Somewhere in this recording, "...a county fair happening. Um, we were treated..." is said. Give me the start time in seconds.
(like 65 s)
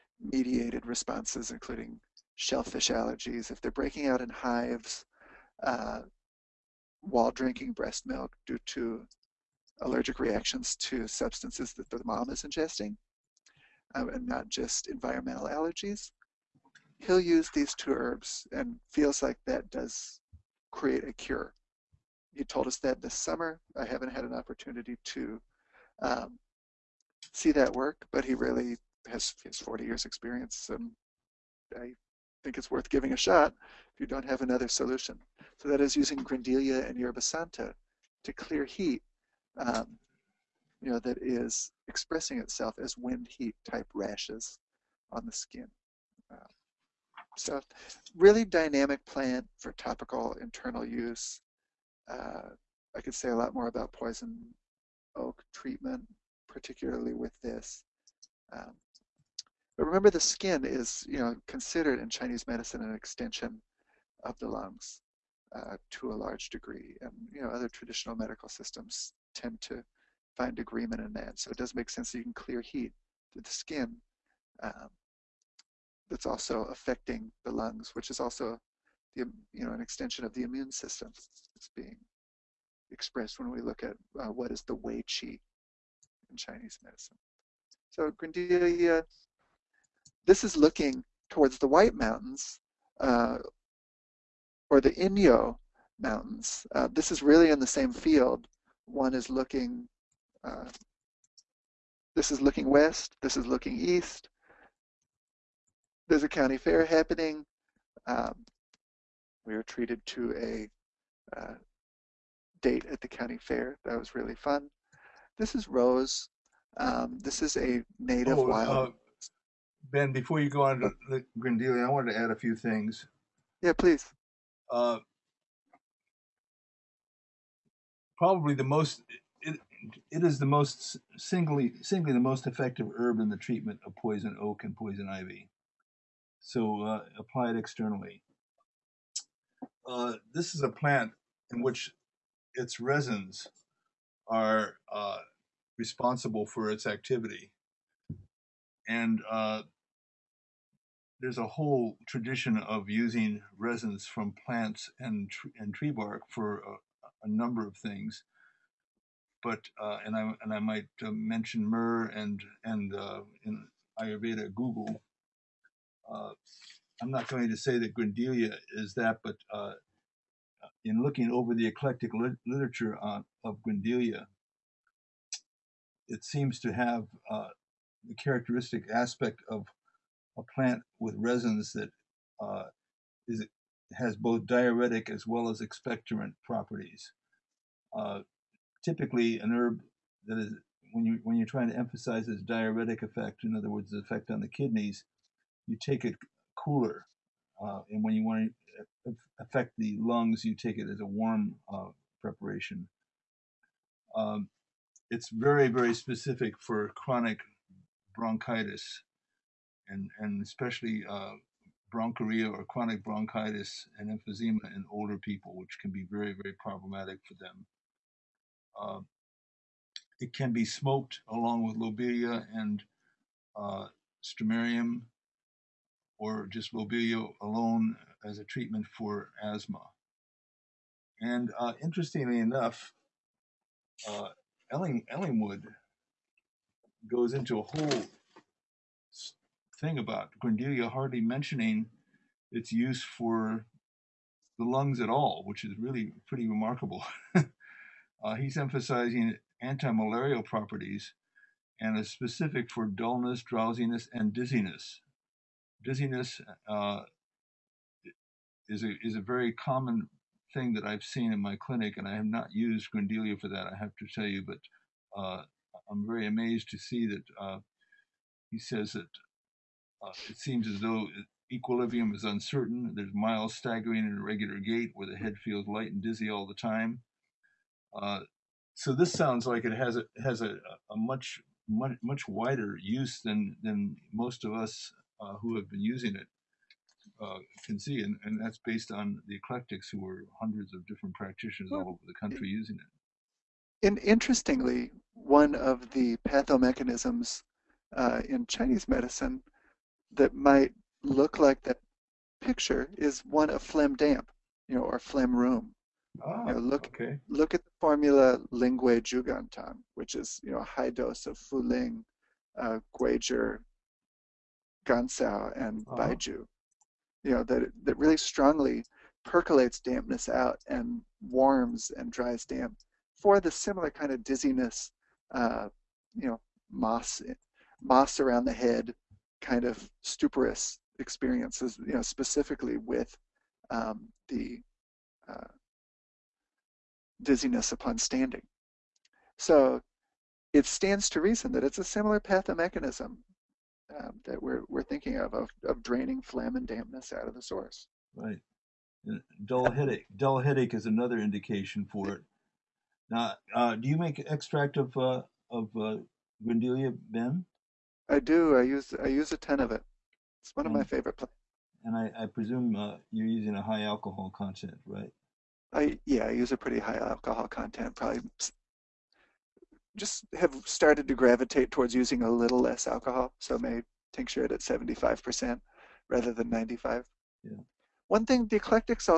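106 s.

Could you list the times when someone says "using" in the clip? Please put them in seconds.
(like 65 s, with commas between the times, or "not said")
35 s, 152 s, 285 s, 292 s, 363 s, 371 s.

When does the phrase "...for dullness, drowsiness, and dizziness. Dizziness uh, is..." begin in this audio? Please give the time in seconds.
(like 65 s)
252 s.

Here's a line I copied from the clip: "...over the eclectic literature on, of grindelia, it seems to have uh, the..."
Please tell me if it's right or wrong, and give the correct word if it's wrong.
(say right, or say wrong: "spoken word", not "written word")
right.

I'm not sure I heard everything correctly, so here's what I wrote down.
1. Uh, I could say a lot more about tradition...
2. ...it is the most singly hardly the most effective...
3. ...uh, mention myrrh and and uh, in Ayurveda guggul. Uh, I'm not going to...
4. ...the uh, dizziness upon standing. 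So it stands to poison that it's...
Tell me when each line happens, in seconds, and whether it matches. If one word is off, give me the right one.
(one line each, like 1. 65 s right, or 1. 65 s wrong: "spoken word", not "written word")
1. 52 s wrong: "poison", not "tradition"
2. 130 s wrong: "singly", not "hardly"
3. 161 s right
4. 334 s wrong: "reason", not "poison".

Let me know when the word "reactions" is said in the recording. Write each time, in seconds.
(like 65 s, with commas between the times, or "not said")
10 s.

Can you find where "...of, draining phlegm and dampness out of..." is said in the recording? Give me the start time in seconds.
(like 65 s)
345 s.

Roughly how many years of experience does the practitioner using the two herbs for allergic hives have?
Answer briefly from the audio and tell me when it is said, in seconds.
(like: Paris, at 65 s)
40, at 29 s.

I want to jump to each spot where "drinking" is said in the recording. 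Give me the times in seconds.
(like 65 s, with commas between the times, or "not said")
7 s.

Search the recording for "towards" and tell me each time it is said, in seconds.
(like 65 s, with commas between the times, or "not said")
91 s, 371 s.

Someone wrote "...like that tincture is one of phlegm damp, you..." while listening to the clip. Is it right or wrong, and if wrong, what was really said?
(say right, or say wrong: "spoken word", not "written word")
wrong: "picture", not "tincture".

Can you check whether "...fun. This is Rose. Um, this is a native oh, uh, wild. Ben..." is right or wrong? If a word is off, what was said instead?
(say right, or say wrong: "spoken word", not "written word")
right.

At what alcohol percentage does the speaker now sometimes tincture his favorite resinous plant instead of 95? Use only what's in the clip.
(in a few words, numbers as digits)
75%.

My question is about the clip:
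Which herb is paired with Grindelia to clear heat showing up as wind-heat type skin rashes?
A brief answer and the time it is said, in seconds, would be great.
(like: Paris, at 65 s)
Yerba Santa, at 36 s.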